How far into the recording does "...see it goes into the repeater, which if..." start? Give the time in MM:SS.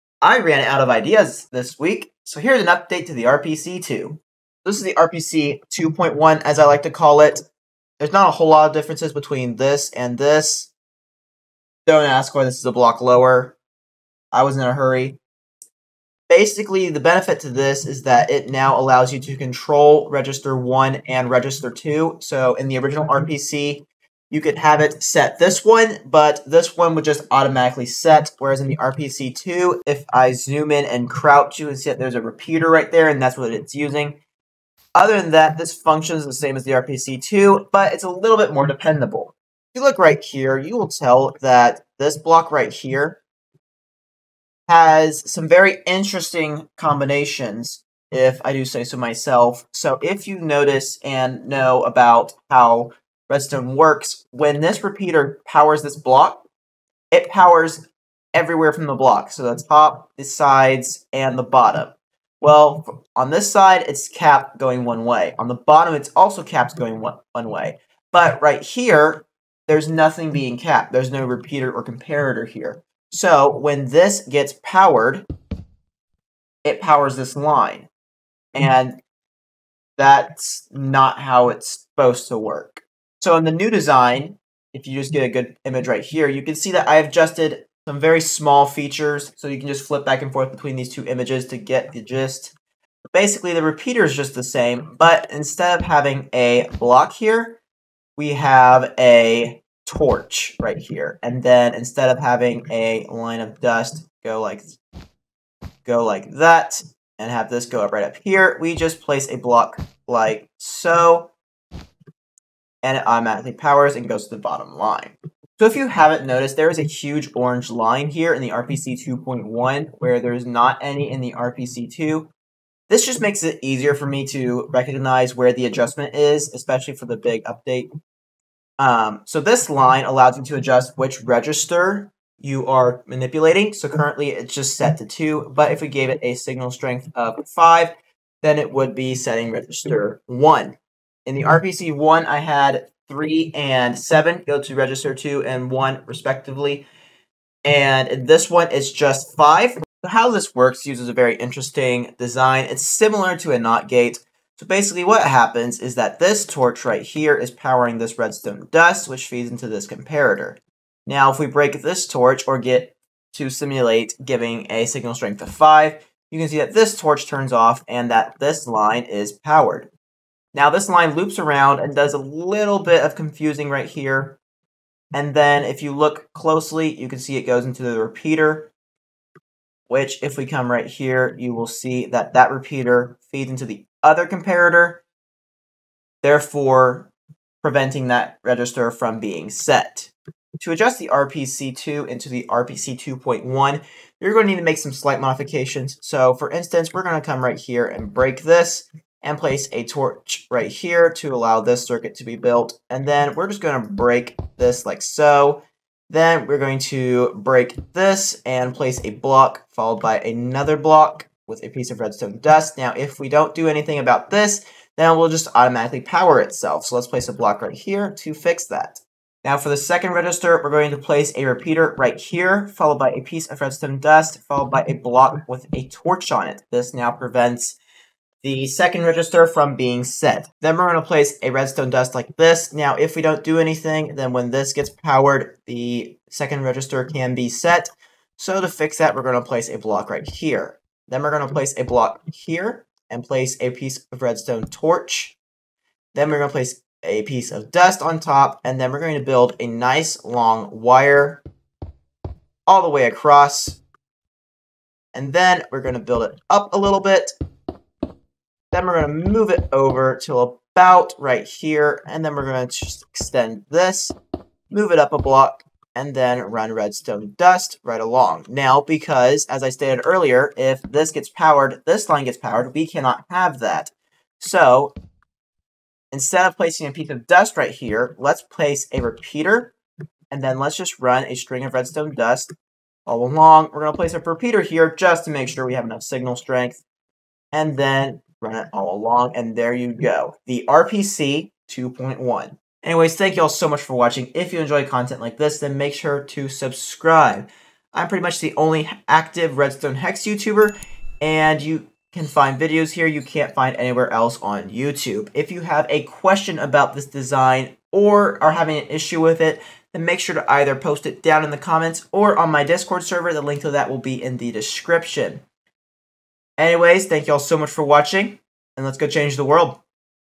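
02:57.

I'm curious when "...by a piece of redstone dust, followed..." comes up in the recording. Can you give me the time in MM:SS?
03:42.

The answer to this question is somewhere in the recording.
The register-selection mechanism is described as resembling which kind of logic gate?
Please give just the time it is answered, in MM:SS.
02:33.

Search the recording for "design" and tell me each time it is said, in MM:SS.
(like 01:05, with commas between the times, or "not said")
01:23, 02:32, 05:07.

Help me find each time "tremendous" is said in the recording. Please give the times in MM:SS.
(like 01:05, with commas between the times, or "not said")
not said.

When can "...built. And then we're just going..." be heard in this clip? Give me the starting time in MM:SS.
03:22.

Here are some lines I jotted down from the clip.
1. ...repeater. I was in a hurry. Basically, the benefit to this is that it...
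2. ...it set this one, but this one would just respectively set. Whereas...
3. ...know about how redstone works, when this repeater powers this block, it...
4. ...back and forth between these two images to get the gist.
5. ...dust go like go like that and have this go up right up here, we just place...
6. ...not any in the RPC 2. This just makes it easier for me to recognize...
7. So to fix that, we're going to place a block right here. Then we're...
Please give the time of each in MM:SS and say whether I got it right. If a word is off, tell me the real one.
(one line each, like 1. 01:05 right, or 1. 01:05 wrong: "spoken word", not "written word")
1. 00:13 wrong: "lower", not "repeater"
2. 00:24 wrong: "automatically", not "respectively"
3. 00:51 right
4. 01:30 right
5. 01:43 right
6. 02:00 right
7. 03:58 right.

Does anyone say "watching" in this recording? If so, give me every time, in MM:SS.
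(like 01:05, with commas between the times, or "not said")
04:53, 05:17.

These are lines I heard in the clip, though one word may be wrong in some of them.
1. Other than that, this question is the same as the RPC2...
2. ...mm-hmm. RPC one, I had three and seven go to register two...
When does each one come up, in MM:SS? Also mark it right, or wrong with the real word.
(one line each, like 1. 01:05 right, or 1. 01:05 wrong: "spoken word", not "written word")
1. 00:34 wrong: "function", not "question"
2. 02:21 right.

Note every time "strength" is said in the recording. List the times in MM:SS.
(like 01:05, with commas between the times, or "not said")
02:16, 02:45, 04:46.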